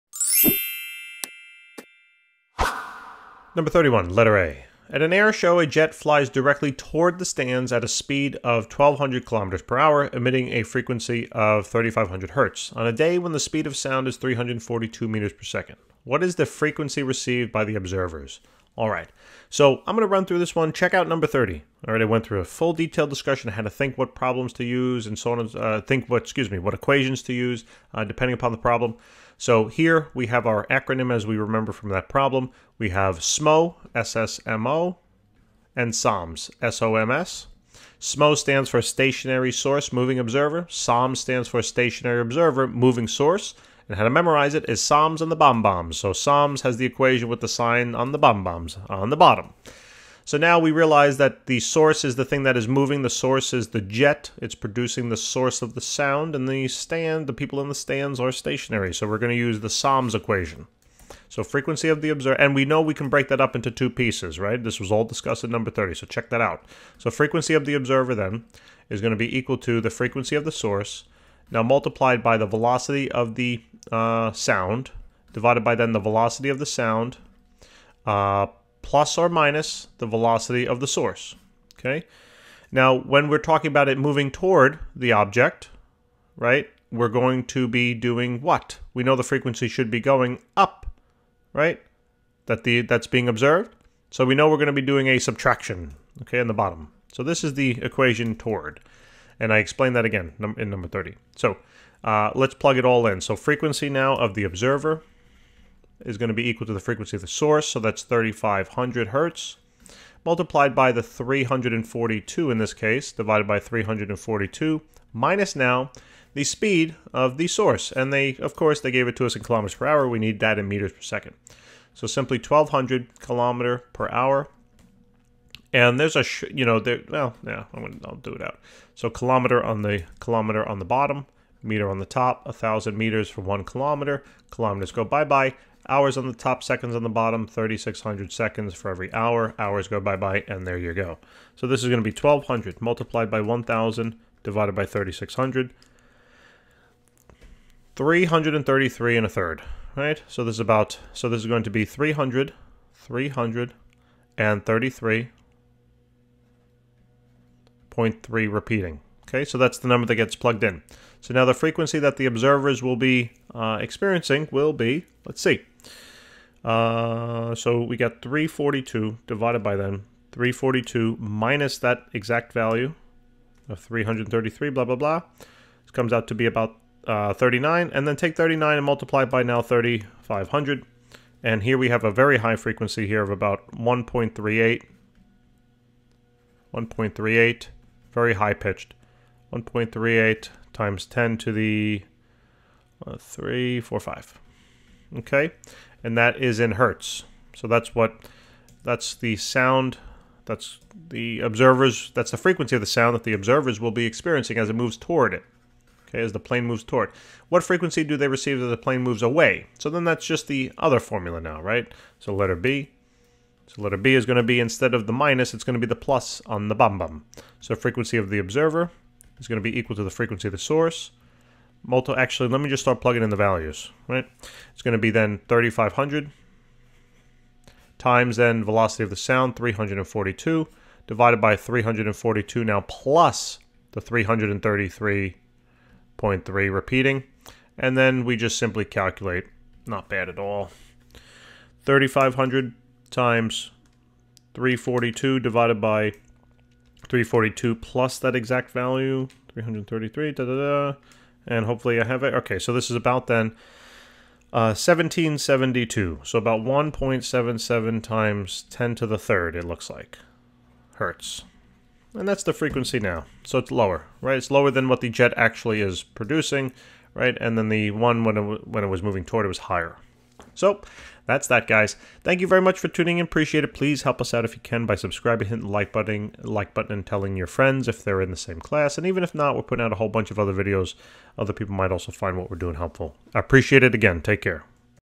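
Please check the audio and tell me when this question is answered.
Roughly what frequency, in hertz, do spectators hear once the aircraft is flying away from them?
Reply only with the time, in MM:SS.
04:14.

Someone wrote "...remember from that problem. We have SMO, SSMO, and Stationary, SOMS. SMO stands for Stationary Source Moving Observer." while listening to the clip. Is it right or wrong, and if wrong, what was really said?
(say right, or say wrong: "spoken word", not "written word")
wrong: "SOMS", not "Stationary".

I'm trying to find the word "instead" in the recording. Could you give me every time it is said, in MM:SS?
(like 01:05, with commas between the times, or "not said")
03:34.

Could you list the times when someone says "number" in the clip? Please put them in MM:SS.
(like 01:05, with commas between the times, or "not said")
00:03, 00:21, 01:05, 01:40, 02:39.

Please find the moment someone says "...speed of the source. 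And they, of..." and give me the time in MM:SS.
01:56.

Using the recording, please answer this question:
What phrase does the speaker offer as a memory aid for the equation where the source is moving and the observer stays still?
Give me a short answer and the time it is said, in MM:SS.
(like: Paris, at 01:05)
Psalms and the Bomb Bombs, at 00:44.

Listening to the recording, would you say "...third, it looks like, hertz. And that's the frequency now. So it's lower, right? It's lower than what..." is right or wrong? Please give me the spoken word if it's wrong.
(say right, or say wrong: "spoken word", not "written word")
right.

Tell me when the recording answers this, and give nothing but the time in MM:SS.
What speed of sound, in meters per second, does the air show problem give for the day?
00:14.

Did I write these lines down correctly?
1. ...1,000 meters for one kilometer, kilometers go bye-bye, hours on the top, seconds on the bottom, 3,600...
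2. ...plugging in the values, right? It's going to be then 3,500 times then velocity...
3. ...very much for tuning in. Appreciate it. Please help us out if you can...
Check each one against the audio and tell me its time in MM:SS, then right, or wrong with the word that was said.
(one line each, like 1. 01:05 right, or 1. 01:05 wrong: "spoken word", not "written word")
1. 02:12 right
2. 03:43 right
3. 04:32 right.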